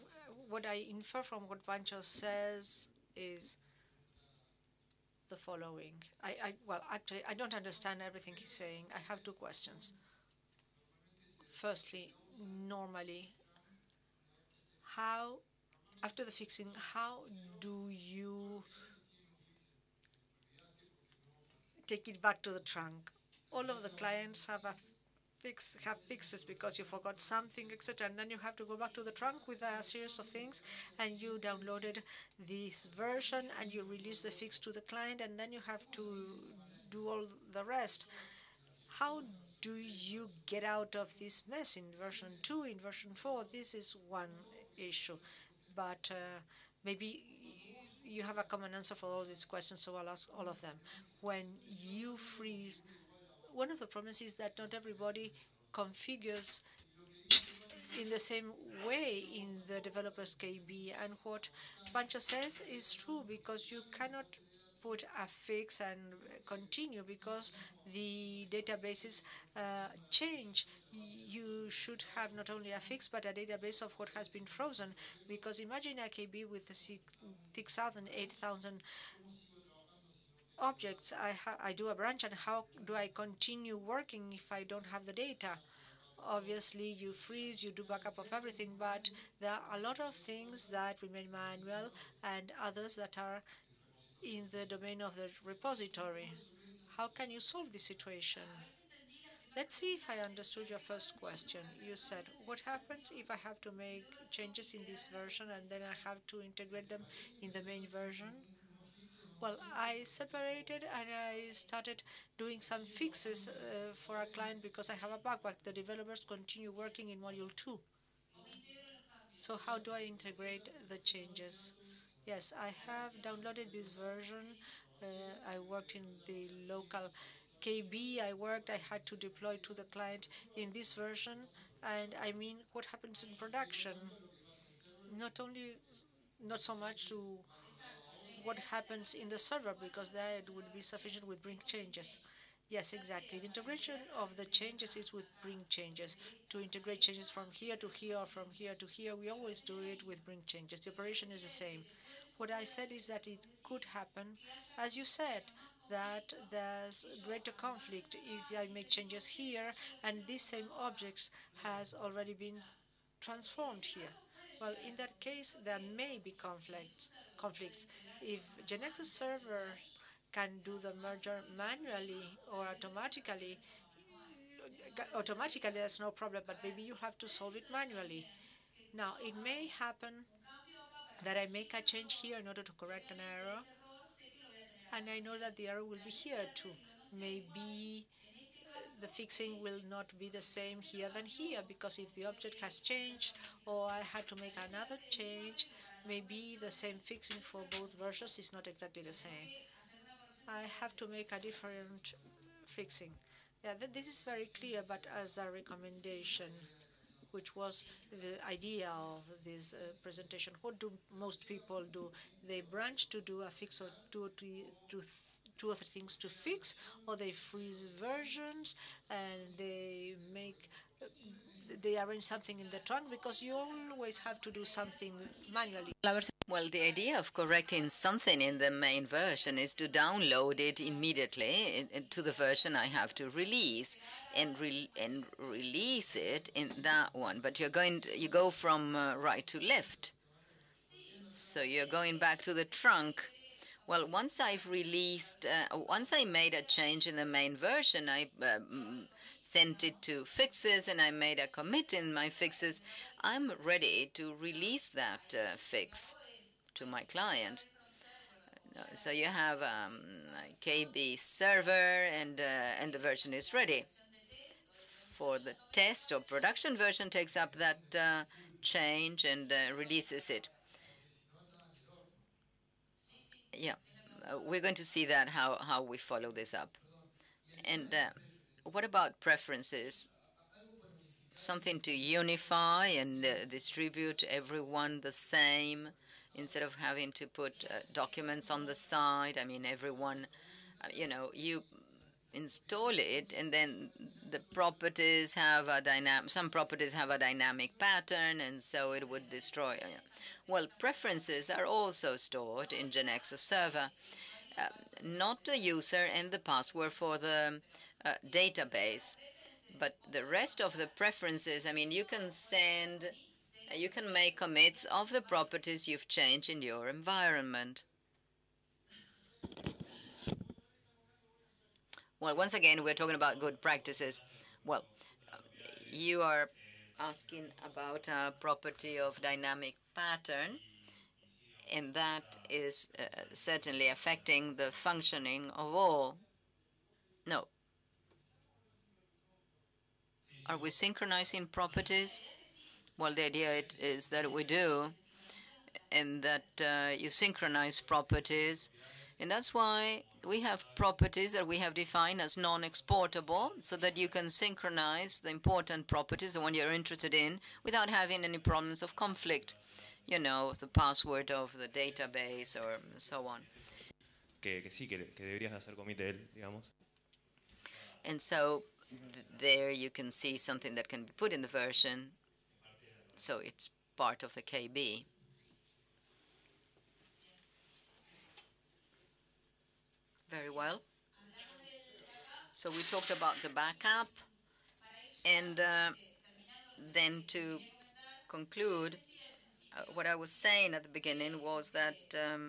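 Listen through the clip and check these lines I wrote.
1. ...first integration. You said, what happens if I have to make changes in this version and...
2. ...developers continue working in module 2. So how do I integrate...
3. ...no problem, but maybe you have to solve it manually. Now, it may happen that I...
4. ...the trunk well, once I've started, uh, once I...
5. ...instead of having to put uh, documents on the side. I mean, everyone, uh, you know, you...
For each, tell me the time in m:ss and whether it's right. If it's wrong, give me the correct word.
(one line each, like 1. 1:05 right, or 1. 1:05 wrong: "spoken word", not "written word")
1. 1:40 wrong: "question", not "integration"
2. 1:55 right
3. 2:55 right
4. 4:02 wrong: "released", not "started"
5. 4:46 right.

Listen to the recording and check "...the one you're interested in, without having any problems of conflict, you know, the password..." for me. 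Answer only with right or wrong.
right.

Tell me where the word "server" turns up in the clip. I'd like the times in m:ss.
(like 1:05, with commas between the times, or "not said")
2:19, 2:49, 4:21, 5:03.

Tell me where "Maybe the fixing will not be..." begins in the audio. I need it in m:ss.
3:07.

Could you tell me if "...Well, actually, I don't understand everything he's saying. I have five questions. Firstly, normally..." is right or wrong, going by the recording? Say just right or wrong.
wrong.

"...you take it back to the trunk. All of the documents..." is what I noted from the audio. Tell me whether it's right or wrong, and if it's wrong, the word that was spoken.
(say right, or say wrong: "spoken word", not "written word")
wrong: "clients", not "documents".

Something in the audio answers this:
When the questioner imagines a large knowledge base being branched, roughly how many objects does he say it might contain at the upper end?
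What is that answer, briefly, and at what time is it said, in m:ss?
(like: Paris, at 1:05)
8,000, at 1:18.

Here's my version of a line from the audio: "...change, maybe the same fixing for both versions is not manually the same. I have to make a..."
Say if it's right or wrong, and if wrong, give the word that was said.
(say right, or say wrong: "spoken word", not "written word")
wrong: "exactly", not "manually".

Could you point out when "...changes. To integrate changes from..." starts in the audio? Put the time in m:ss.
2:25.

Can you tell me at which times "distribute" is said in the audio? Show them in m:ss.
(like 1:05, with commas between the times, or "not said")
4:43.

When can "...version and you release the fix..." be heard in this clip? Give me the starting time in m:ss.
0:32.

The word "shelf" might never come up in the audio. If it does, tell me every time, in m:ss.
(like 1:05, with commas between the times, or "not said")
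not said.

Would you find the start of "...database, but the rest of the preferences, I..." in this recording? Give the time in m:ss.
5:08.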